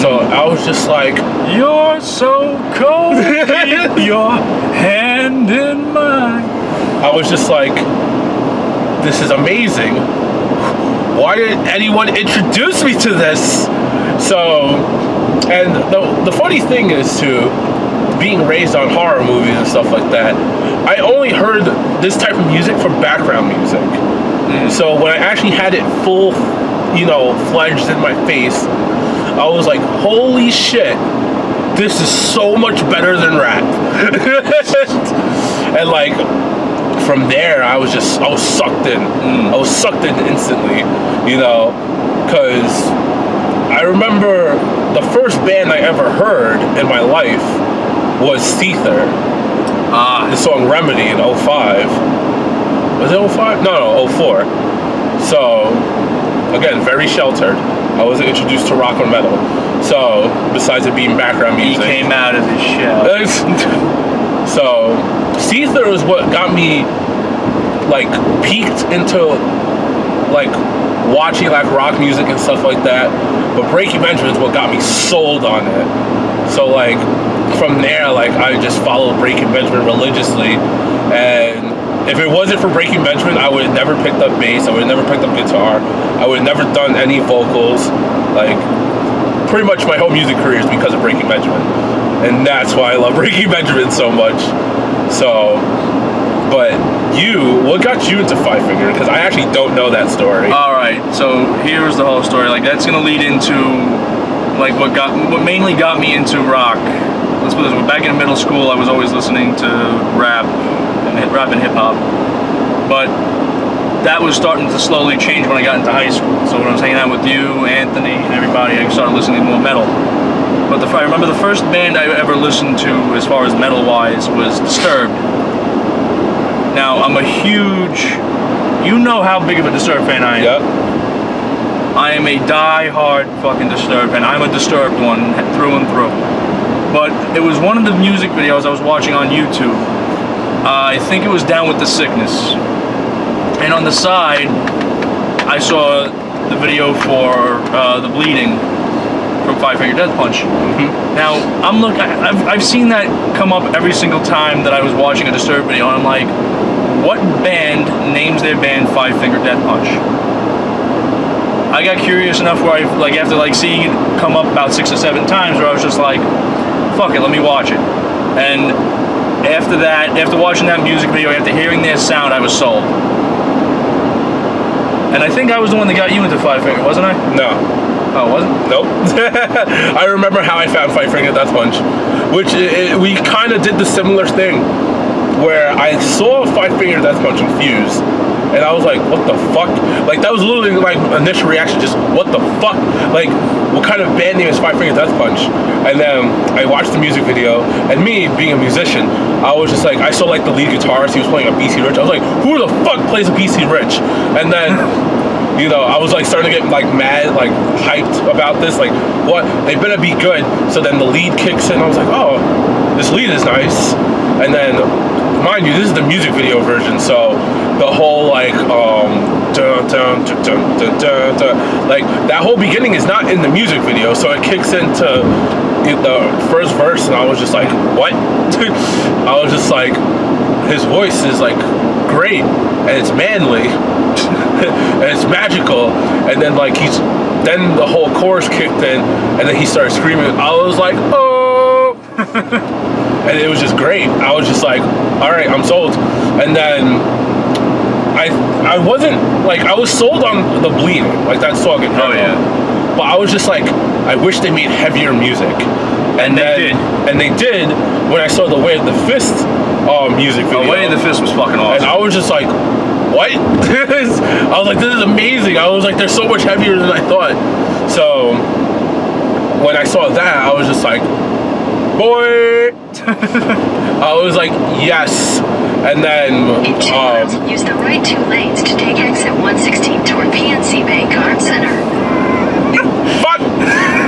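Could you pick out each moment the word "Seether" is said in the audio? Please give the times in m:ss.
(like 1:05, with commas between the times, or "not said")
0:48, 1:05.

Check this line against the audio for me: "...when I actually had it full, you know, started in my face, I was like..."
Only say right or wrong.
wrong.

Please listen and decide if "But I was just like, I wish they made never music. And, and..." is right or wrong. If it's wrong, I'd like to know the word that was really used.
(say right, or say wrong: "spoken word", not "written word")
wrong: "heavier", not "never".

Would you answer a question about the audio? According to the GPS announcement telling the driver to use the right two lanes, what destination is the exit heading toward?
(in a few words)
PNC Bank Arts Center.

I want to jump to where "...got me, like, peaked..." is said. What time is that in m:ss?
1:06.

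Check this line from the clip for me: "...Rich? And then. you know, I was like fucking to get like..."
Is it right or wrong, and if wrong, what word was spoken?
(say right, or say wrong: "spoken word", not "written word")
wrong: "starting", not "fucking".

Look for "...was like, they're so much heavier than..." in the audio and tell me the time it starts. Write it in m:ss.
4:25.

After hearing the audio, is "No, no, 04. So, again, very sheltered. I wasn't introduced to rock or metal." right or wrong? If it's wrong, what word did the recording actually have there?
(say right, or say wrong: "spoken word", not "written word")
right.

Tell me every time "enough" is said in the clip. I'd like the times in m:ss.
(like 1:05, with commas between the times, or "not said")
2:42.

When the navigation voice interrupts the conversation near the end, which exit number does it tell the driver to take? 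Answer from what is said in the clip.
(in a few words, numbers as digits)
116.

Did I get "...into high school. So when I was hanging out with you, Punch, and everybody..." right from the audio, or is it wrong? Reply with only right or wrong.
wrong.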